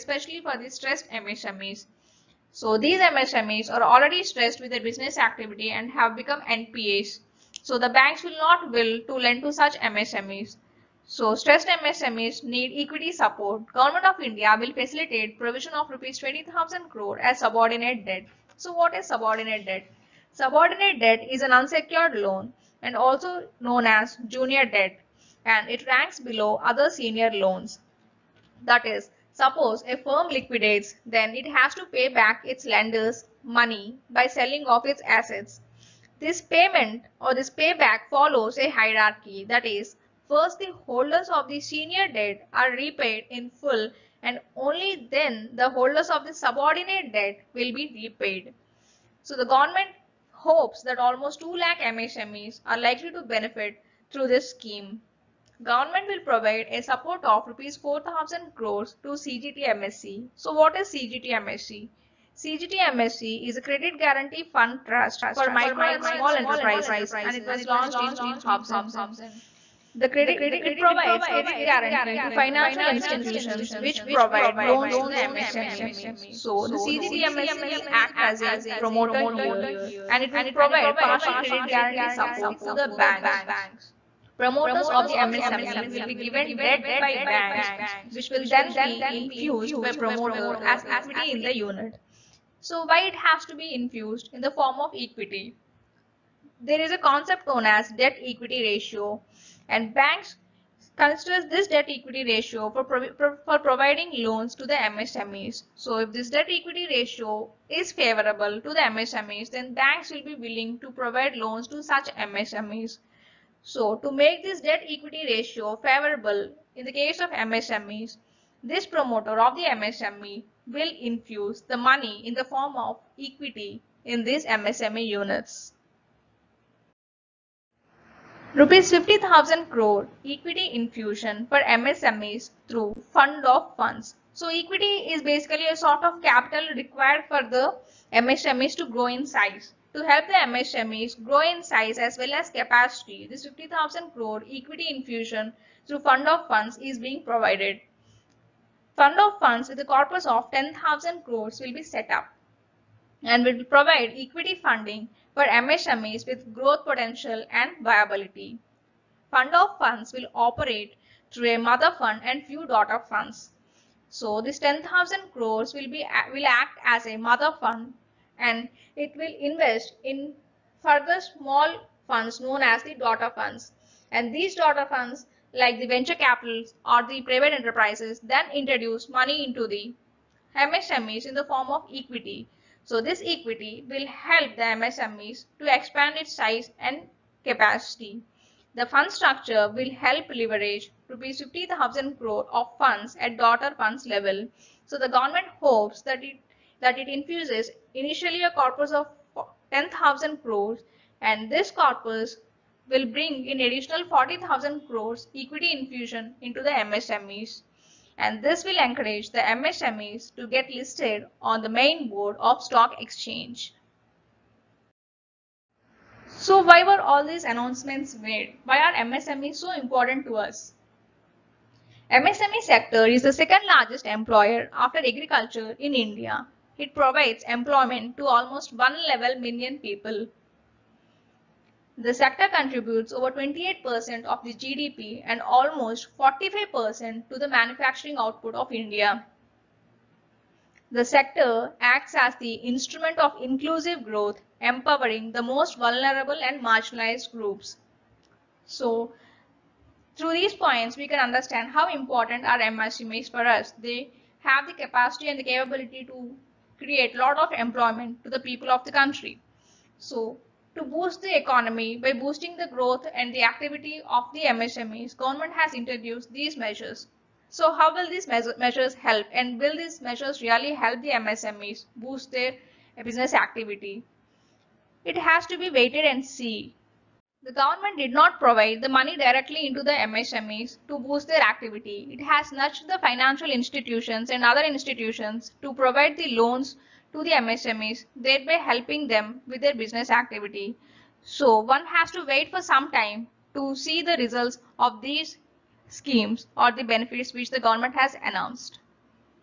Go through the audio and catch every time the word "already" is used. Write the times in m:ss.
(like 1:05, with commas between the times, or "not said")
0:03.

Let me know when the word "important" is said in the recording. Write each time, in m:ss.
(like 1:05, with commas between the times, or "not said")
3:39, 4:11.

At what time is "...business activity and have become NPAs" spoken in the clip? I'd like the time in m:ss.
0:04.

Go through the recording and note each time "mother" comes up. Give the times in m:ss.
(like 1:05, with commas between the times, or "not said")
2:41, 2:47.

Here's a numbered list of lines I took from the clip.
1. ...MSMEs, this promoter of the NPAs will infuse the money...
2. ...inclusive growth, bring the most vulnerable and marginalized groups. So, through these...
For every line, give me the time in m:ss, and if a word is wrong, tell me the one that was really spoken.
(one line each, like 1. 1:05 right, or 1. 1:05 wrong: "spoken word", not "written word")
1. 1:57 wrong: "MSME", not "NPAs"
2. 4:03 wrong: "empowering", not "bring".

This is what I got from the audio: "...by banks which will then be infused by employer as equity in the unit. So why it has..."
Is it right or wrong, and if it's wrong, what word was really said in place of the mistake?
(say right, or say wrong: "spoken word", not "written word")
wrong: "promoter", not "employer".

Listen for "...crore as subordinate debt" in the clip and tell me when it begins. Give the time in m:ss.
0:16.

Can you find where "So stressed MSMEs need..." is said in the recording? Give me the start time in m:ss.
0:11.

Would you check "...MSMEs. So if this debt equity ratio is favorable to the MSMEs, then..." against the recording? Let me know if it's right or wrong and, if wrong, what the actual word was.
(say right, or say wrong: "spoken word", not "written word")
right.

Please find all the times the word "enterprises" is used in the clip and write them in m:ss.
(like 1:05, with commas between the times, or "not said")
1:06, 2:57.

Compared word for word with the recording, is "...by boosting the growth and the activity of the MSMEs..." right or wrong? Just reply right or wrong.
right.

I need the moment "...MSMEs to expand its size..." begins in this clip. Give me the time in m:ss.
3:04.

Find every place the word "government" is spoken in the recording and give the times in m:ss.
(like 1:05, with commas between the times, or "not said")
0:13, 0:49, 0:55, 3:15, 4:25, 4:37, 4:57.